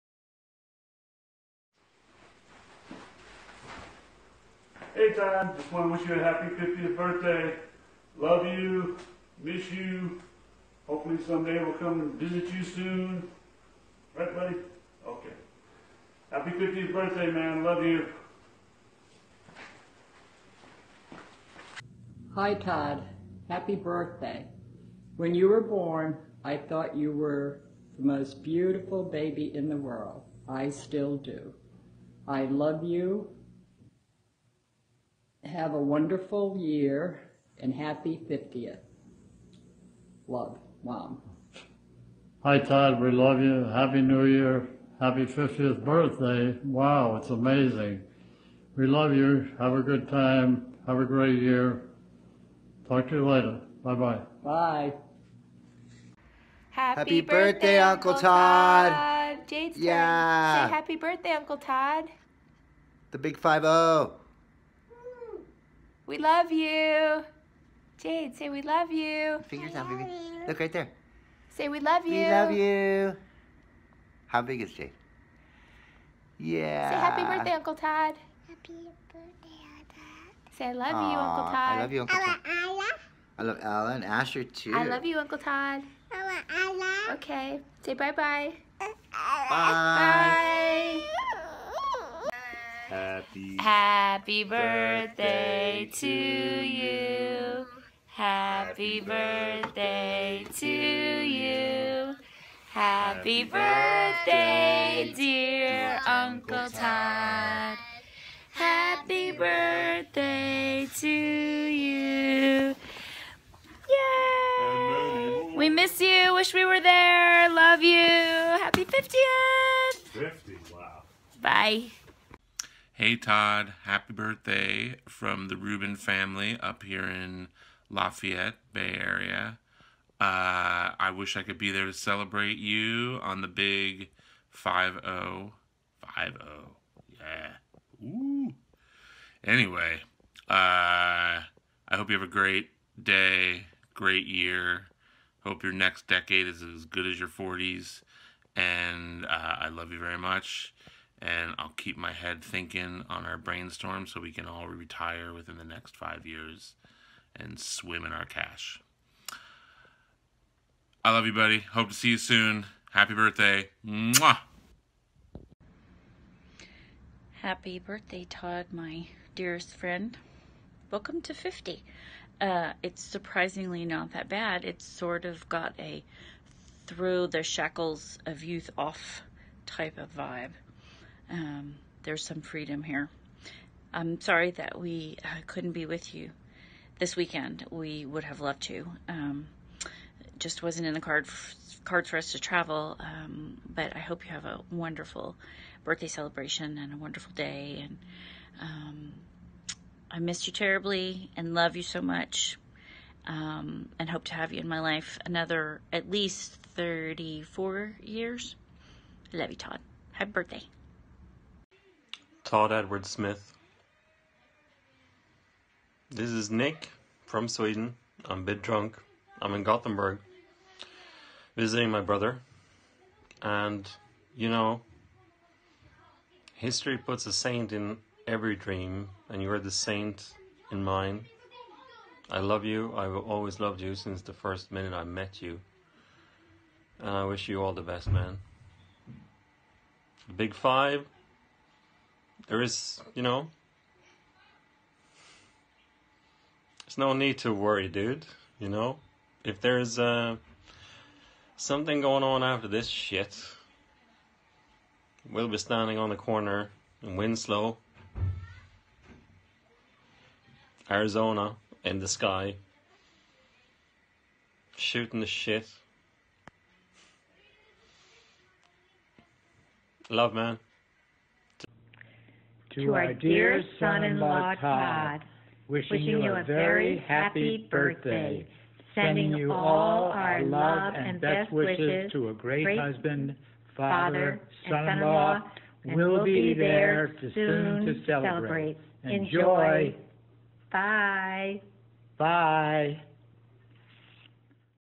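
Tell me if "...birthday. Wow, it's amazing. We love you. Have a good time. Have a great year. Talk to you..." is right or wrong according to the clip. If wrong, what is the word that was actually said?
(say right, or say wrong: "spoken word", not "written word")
right.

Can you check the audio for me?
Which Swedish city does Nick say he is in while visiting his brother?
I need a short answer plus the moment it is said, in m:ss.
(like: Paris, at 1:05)
Gothenburg, at 3:39.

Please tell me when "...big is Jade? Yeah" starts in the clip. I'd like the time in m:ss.
1:14.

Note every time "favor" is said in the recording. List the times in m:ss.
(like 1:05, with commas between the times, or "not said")
not said.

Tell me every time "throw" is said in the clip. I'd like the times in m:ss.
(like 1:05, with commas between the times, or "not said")
2:56.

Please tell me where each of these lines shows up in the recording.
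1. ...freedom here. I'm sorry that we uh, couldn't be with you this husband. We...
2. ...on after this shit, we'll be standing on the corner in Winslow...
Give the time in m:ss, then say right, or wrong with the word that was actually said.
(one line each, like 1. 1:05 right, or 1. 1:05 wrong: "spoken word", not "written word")
1. 3:02 wrong: "weekend", not "husband"
2. 4:12 right.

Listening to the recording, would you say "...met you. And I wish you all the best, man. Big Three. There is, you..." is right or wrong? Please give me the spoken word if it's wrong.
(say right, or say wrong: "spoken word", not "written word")
wrong: "Five", not "Three".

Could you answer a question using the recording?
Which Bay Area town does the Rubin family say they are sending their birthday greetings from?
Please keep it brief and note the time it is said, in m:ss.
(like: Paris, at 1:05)
Lafayette, at 2:07.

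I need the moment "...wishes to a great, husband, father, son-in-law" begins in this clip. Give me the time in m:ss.
4:41.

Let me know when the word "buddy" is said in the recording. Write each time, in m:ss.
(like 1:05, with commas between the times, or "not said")
0:14, 2:41.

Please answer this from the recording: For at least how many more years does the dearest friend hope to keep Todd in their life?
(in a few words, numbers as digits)
34.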